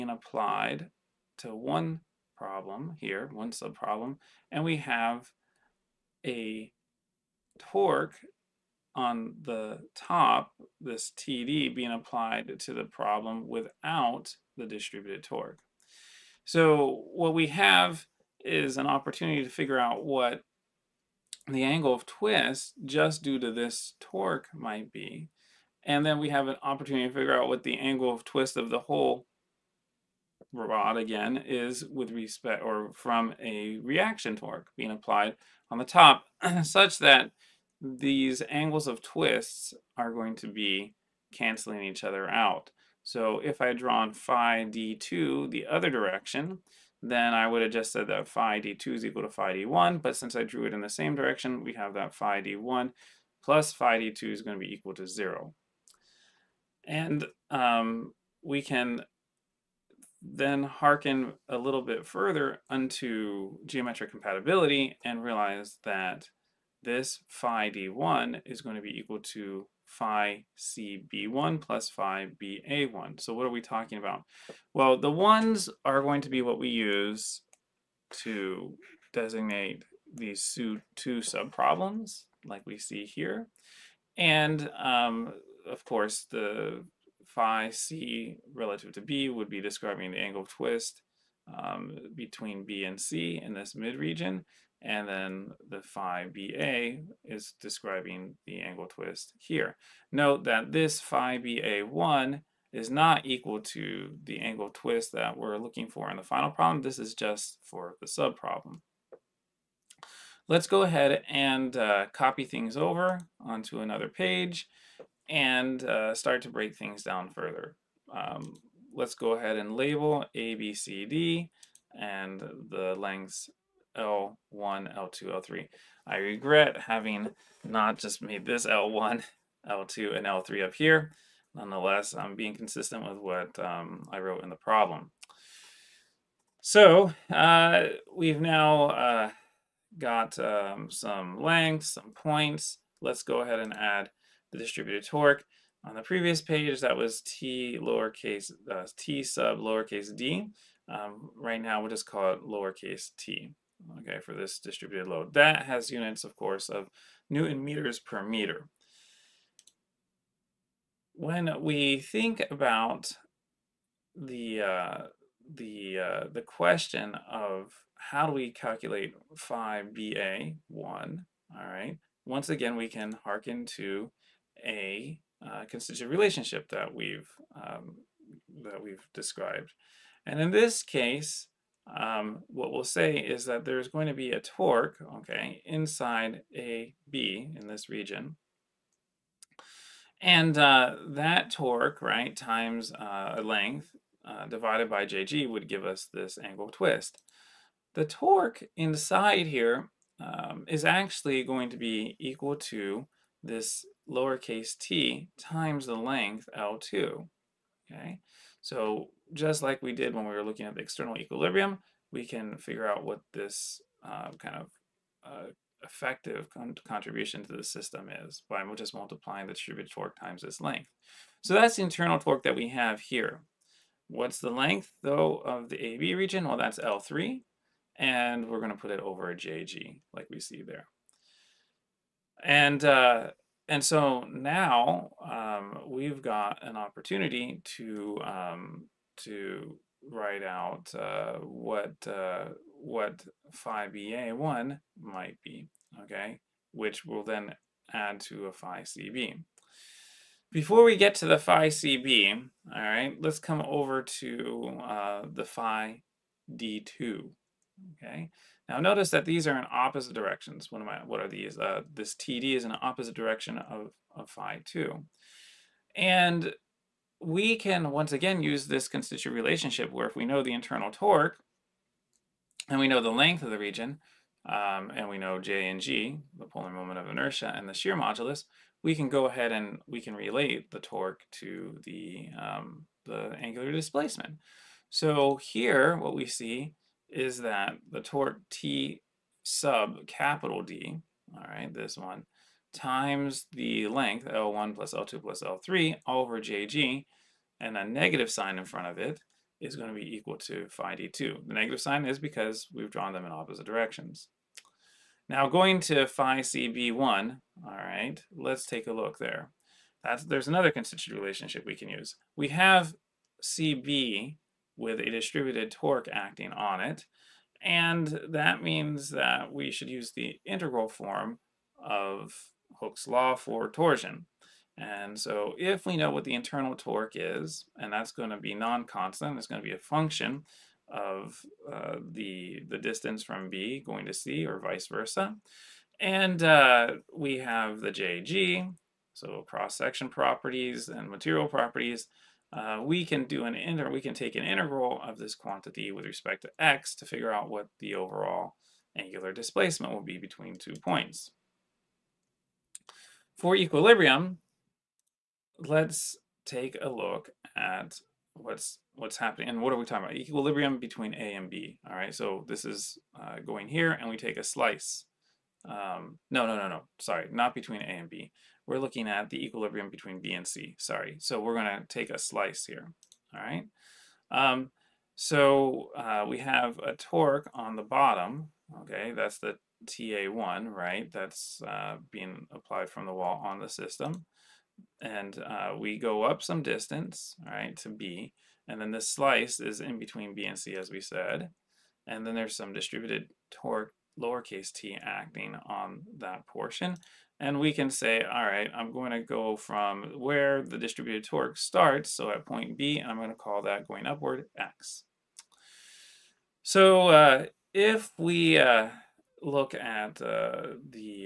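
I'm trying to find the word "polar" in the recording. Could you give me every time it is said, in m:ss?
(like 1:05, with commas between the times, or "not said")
4:36.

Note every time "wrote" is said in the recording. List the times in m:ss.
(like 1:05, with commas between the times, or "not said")
2:14.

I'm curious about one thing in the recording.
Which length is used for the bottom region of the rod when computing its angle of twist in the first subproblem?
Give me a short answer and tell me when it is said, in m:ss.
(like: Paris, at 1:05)
L3, at 3:46.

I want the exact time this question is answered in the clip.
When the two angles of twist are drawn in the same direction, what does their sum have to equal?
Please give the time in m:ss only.
0:54.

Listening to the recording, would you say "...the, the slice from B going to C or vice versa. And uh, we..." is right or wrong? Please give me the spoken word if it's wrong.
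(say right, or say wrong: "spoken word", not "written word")
wrong: "distance", not "slice".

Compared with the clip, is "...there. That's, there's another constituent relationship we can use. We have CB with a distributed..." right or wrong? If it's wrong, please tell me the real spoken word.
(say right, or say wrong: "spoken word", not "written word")
right.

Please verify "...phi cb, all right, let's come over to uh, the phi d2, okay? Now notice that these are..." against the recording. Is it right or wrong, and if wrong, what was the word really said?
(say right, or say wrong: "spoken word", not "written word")
right.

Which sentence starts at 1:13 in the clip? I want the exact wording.
So what are we talking about?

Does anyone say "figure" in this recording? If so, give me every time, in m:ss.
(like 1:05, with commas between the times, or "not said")
0:19, 0:27, 3:32, 5:47.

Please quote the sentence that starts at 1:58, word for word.
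Um, let's go ahead and label A, B, C, D, and the lengths L1, L2, L3.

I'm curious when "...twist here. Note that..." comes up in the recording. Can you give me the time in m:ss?
1:38.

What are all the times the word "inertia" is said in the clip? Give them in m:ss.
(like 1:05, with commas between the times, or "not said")
4:37.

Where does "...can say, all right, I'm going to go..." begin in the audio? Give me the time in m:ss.
6:37.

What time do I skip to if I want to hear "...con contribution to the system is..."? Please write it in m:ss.
3:36.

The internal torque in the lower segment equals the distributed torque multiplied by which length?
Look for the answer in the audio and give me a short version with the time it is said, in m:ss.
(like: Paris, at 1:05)
L2, at 3:25.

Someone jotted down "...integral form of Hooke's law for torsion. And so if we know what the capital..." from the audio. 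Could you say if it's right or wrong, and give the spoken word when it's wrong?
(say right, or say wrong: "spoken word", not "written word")
wrong: "internal", not "capital".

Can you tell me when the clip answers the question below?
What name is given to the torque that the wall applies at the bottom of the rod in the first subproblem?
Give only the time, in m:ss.
6:19.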